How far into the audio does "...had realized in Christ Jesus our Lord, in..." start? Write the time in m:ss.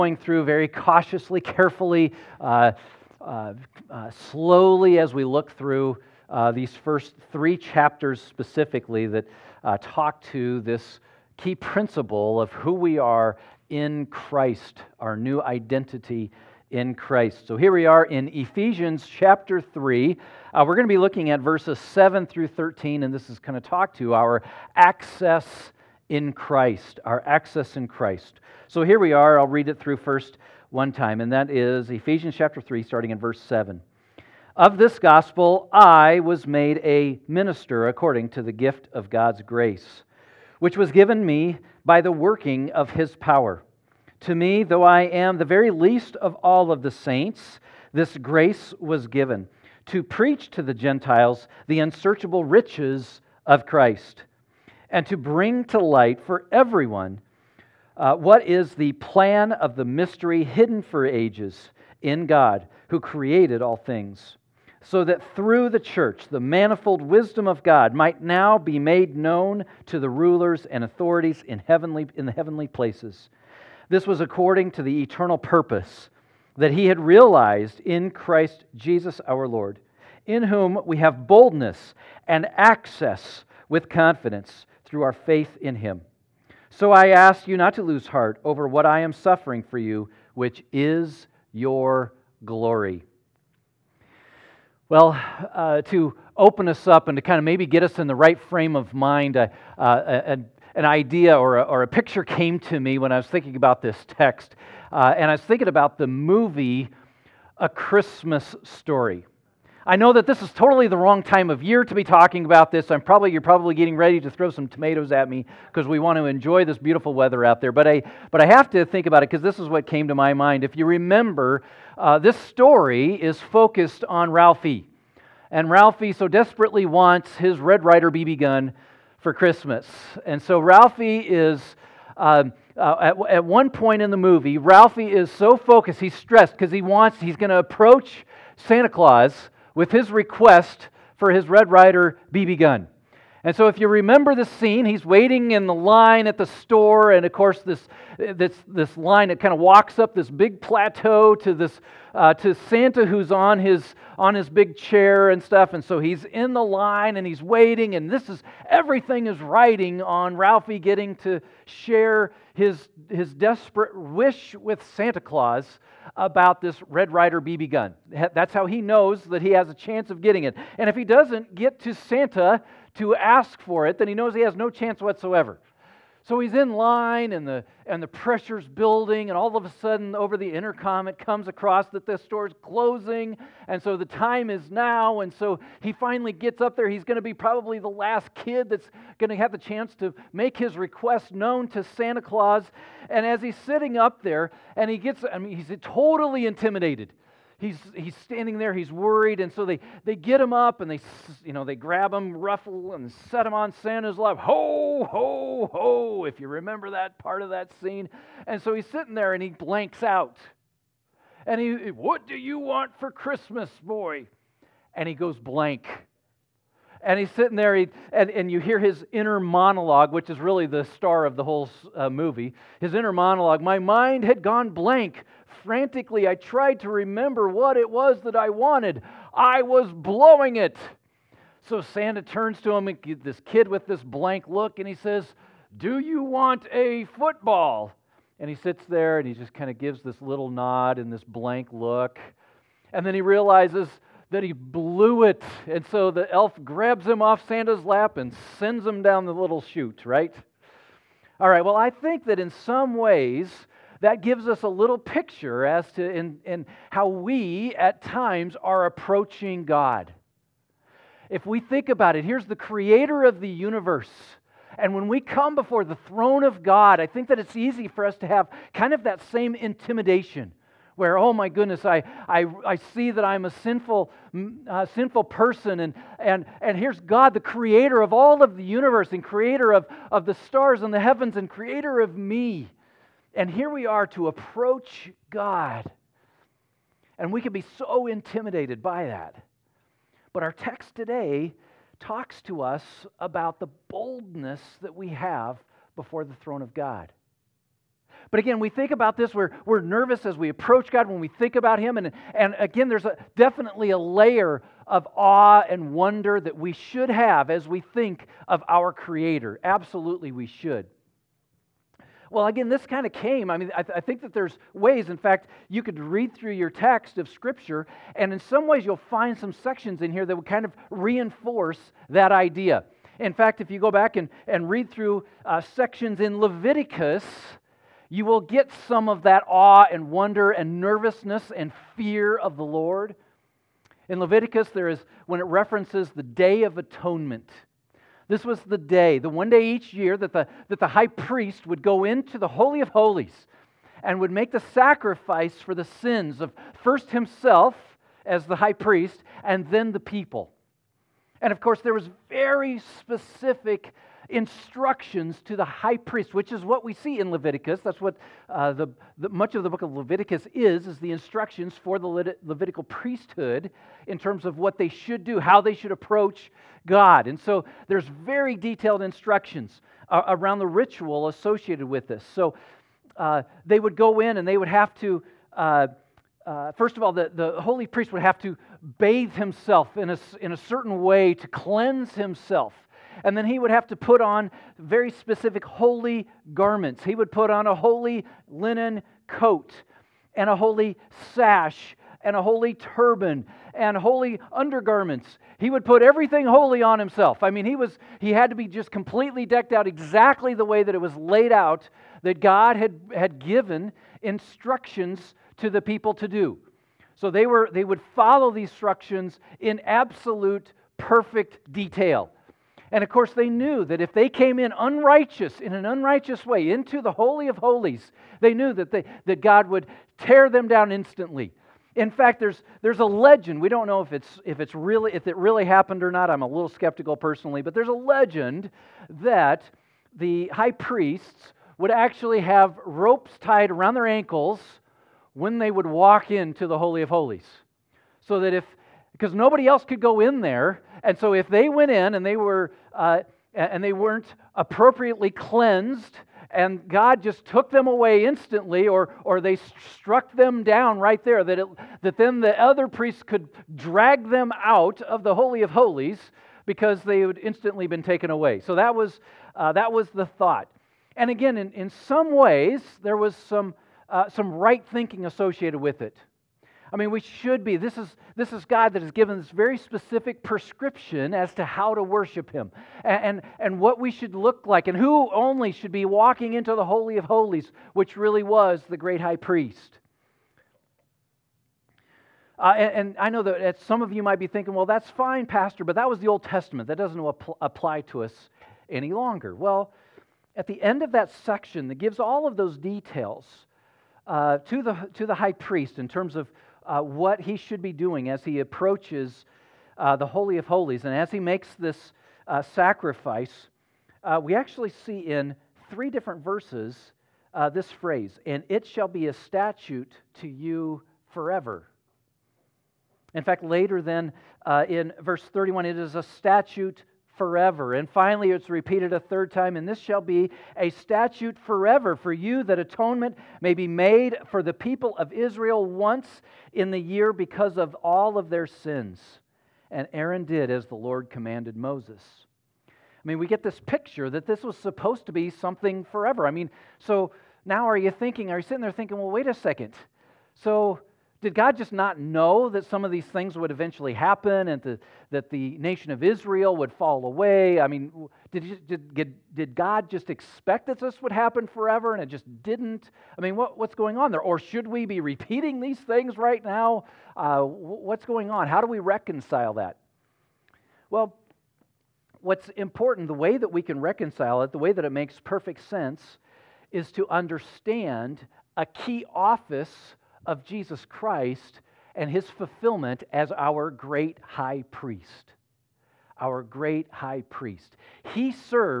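1:16.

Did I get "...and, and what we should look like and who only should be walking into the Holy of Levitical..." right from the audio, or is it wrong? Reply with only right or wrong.
wrong.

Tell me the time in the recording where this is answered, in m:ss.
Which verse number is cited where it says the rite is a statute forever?
8:35.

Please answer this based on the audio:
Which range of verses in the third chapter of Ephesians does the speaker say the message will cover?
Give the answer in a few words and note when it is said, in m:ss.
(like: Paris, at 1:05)
7 through 13, at 0:21.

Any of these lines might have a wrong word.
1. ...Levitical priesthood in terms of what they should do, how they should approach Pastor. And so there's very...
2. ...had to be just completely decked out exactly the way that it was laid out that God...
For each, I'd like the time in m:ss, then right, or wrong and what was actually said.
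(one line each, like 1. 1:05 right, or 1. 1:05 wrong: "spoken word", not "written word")
1. 6:02 wrong: "God", not "Pastor"
2. 6:38 right.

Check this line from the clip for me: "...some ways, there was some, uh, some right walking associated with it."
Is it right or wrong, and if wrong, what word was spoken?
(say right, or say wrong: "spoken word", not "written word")
wrong: "thinking", not "walking".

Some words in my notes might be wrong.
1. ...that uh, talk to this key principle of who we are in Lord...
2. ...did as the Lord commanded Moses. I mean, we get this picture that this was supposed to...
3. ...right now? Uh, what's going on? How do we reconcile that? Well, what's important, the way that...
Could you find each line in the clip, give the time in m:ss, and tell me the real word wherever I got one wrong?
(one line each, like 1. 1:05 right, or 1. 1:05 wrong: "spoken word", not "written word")
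1. 0:09 wrong: "Christ", not "Lord"
2. 8:50 right
3. 9:16 right.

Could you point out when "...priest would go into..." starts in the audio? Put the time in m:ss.
5:41.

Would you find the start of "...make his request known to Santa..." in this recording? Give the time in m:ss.
3:10.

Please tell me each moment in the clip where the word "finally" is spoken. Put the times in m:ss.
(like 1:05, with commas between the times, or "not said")
3:05, 8:38.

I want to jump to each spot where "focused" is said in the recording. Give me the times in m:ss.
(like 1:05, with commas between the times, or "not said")
2:03, 2:15.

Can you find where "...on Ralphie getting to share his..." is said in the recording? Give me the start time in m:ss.
2:40.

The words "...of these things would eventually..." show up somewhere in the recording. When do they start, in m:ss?
9:03.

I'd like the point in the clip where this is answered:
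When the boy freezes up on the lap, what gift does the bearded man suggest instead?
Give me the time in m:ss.
3:56.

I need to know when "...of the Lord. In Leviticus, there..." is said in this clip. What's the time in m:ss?
5:32.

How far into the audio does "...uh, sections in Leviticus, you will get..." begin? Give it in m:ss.
5:25.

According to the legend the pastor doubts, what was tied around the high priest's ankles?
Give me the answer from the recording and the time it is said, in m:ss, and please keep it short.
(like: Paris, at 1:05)
Ropes, at 7:12.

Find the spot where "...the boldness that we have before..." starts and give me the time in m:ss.
4:53.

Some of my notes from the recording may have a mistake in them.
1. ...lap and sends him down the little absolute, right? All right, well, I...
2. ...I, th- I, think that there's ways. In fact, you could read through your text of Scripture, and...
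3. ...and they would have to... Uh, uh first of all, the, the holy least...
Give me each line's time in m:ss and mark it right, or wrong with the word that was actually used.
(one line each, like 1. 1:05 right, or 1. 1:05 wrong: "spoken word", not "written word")
1. 4:07 wrong: "chute", not "absolute"
2. 5:13 right
3. 6:14 wrong: "priest", not "least".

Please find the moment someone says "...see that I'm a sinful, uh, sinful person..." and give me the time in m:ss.
4:32.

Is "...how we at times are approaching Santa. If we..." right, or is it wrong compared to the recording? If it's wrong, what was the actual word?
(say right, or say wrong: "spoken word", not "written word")
wrong: "God", not "Santa".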